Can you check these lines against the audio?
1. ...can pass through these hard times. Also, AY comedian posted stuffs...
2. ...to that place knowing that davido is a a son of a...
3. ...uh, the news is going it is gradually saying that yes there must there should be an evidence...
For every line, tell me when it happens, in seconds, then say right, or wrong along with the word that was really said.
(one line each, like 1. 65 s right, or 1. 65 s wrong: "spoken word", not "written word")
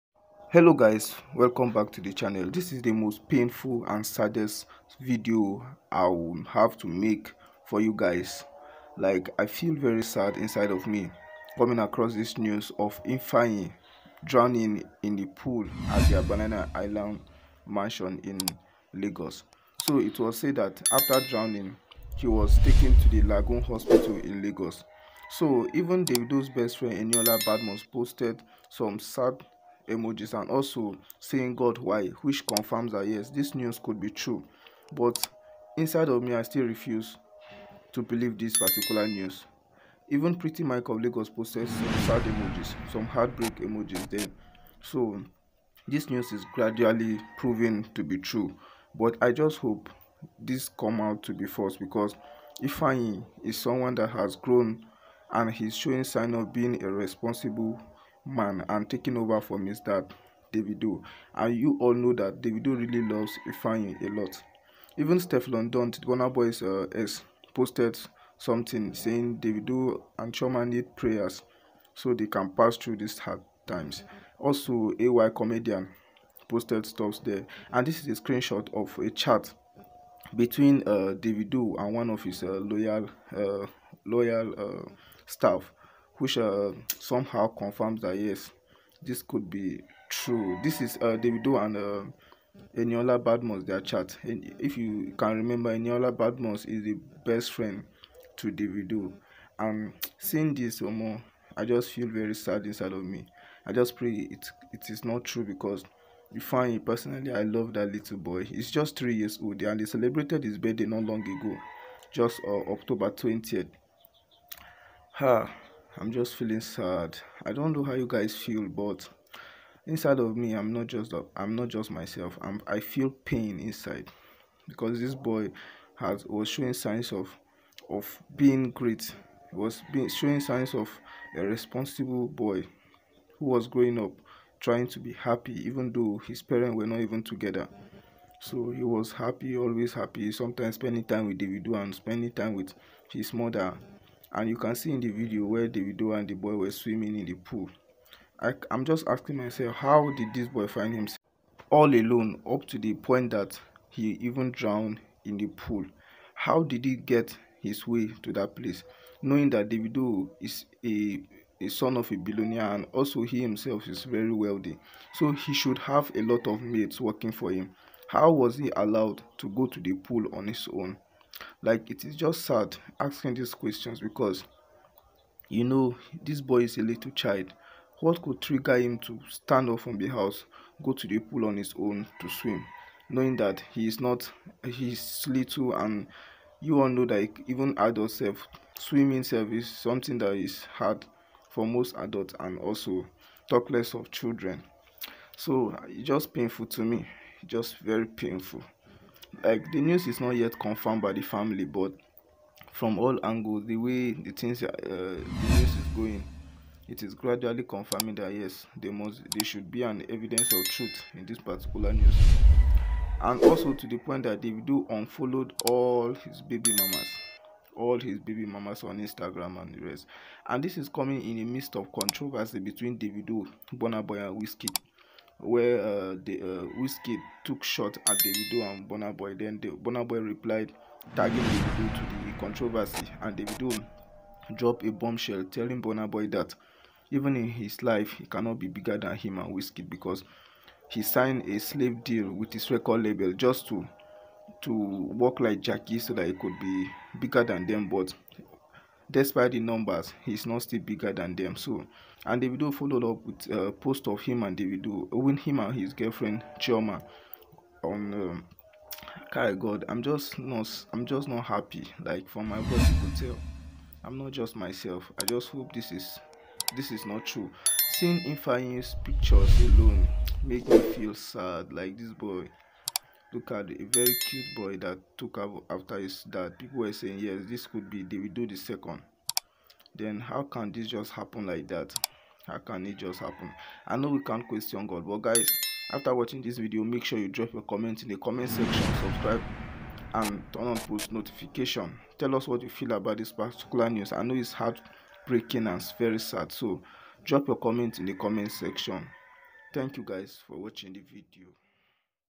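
1. 72 s right
2. 158 s right
3. 204 s wrong: "confirming", not "saying".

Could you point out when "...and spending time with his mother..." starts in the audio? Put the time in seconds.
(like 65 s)
141 s.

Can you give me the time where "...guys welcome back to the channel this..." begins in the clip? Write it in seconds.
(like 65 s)
0 s.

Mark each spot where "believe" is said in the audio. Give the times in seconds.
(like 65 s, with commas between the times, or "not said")
38 s.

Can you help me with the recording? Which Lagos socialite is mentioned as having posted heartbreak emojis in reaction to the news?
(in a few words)
Pretty Mike.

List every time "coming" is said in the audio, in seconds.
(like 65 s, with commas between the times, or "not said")
11 s, 220 s.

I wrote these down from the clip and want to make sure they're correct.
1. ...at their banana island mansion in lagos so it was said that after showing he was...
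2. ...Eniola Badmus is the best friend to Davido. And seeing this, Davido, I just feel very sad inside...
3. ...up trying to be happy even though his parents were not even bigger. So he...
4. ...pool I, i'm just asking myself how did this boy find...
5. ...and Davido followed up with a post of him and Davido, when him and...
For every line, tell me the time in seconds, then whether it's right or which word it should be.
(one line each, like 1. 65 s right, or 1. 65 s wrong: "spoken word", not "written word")
1. 15 s wrong: "drowning", not "showing"
2. 95 s wrong: "Omo", not "Davido"
3. 133 s wrong: "together", not "bigger"
4. 147 s right
5. 252 s right.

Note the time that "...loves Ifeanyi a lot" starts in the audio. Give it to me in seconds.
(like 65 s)
63 s.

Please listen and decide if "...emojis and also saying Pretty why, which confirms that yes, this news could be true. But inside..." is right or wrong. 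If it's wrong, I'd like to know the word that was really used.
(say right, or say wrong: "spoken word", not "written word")
wrong: "God", not "Pretty".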